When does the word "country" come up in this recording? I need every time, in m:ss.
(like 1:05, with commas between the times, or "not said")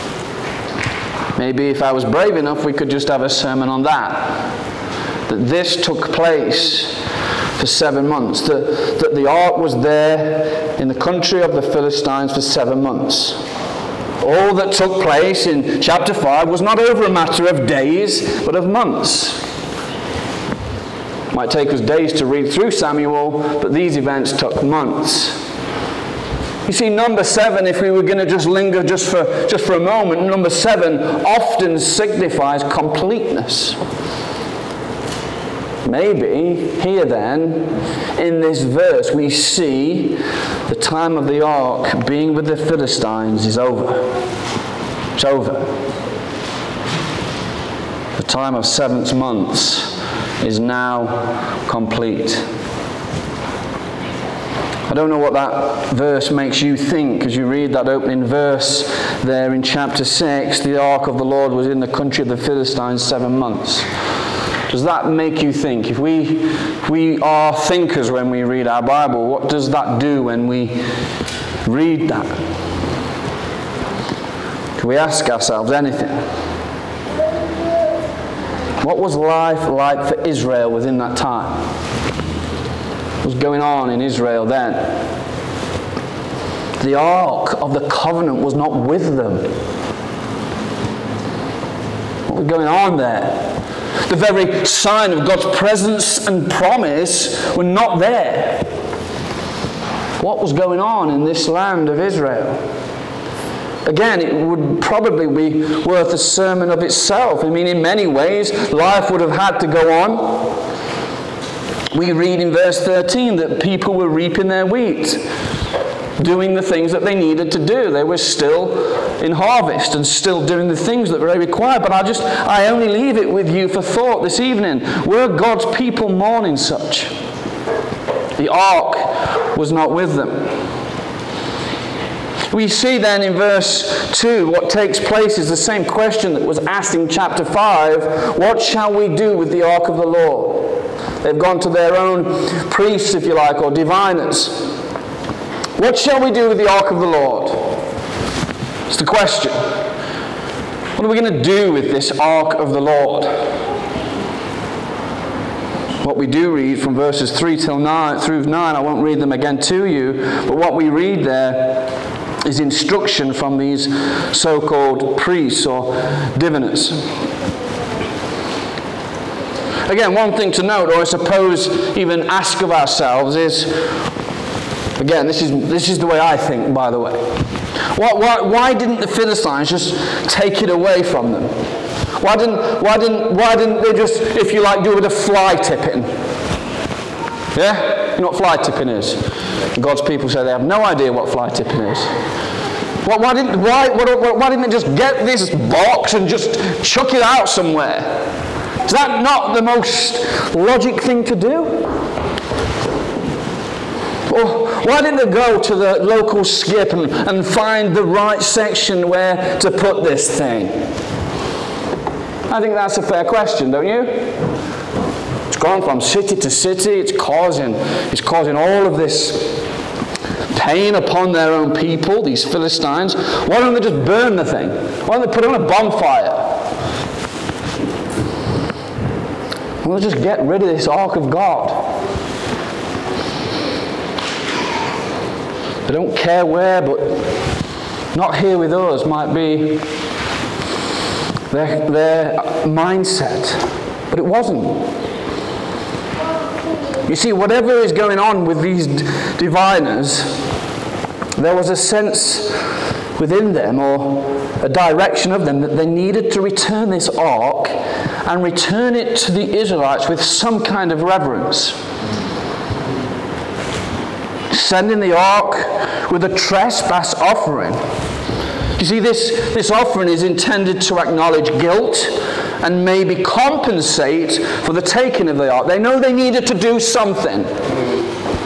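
0:10, 1:01.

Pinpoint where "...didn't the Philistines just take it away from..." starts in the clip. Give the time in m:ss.
2:58.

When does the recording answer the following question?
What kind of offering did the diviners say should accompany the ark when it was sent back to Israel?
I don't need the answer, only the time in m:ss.
4:26.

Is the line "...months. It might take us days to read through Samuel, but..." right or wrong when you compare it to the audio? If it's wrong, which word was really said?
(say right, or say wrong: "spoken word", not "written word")
right.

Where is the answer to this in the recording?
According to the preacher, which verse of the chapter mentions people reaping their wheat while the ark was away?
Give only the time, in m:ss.
1:52.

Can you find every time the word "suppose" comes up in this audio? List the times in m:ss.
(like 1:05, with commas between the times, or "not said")
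2:51.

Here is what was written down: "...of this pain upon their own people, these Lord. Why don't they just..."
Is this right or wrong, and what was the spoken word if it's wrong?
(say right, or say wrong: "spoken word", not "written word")
wrong: "Philistines", not "Lord".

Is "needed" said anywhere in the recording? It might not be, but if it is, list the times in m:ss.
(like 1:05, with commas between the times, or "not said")
1:57, 4:15, 4:36.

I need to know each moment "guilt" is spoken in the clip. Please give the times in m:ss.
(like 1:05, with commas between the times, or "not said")
4:31.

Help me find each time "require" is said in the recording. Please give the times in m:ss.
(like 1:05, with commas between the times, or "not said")
2:01.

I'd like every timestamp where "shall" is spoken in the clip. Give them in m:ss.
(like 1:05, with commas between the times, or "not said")
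2:18, 2:25.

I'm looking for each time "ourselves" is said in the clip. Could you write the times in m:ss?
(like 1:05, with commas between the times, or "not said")
1:15, 2:52.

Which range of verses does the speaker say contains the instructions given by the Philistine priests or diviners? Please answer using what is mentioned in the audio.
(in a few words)
3 through 9.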